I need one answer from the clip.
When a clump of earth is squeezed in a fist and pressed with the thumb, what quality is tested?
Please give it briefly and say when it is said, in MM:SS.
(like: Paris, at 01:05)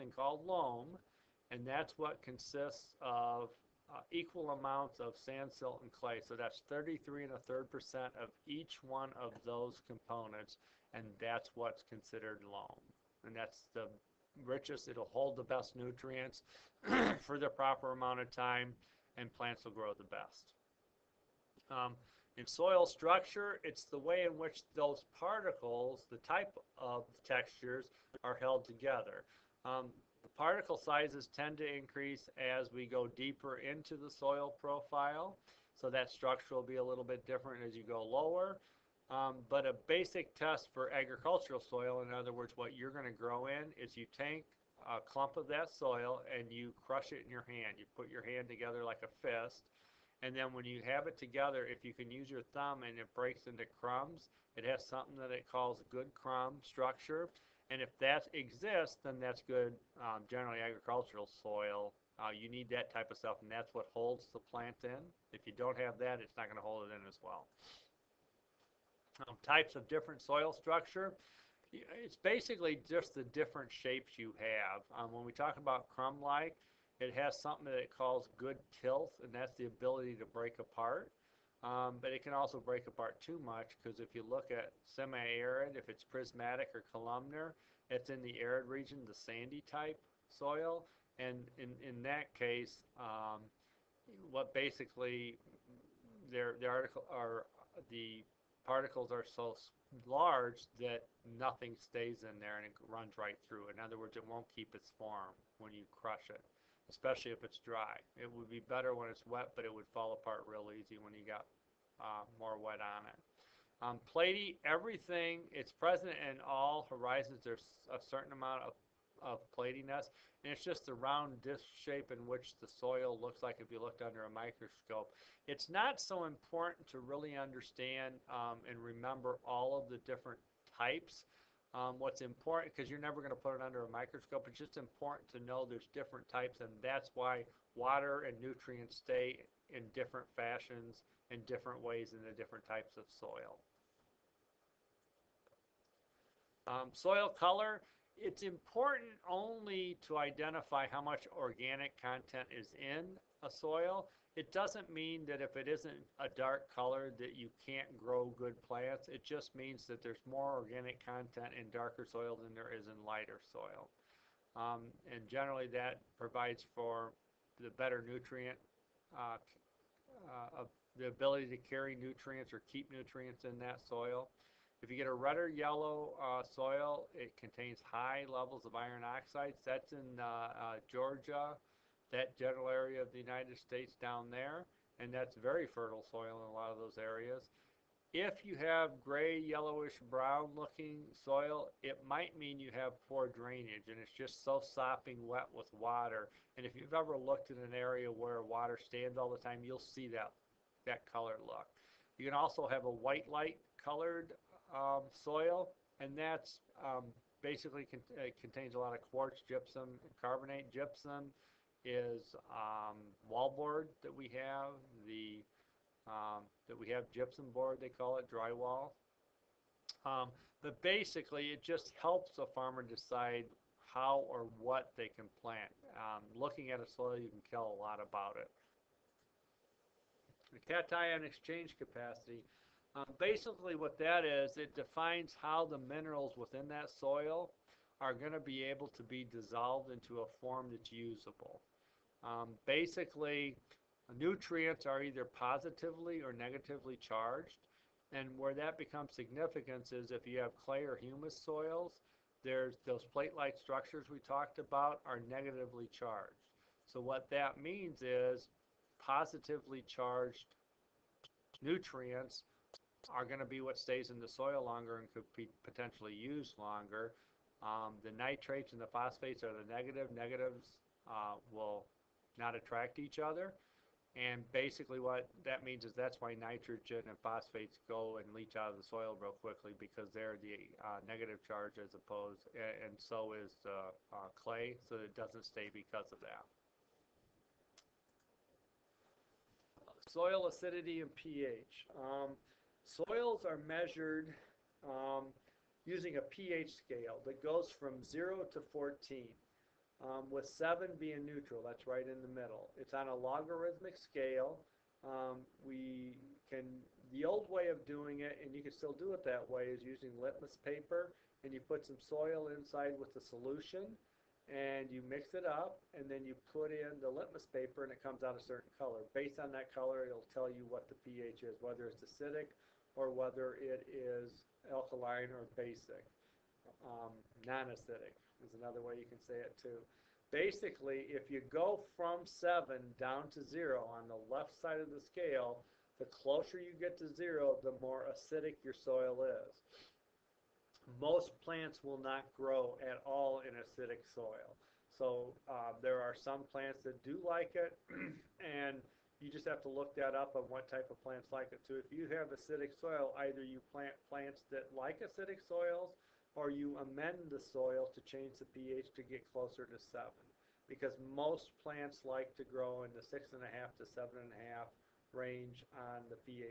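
good crumb structure, at 00:55.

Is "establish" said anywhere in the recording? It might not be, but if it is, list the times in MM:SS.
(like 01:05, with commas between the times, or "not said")
not said.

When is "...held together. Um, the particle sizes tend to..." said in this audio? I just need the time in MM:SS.
00:28.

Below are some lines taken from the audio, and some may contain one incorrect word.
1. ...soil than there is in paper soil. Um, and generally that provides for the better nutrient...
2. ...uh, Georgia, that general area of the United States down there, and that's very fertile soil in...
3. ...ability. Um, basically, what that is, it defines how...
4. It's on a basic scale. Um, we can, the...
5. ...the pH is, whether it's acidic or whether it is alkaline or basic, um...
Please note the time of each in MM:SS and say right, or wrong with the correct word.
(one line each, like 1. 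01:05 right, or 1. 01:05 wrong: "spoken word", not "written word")
1. 02:42 wrong: "lighter", not "paper"
2. 03:00 right
3. 03:51 wrong: "capacity", not "ability"
4. 05:02 wrong: "logarithmic", not "basic"
5. 05:20 right.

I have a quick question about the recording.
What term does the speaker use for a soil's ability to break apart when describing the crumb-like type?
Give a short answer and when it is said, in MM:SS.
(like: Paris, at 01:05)
good tilth, at 01:18.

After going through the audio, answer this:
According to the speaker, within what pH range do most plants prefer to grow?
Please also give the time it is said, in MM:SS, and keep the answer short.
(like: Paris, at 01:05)
6.5 to 7.5, at 06:03.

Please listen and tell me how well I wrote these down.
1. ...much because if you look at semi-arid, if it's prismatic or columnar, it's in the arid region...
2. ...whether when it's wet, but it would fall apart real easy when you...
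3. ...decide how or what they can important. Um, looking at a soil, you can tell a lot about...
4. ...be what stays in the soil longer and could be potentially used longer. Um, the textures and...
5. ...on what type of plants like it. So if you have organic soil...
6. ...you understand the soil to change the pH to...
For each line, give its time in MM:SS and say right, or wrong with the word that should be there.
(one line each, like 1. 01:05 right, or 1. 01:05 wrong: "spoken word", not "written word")
1. 01:23 right
2. 01:48 wrong: "better", not "whether"
3. 03:42 wrong: "plant", not "important"
4. 04:23 wrong: "nitrates", not "textures"
5. 05:50 wrong: "acidic", not "organic"
6. 05:56 wrong: "amend", not "understand".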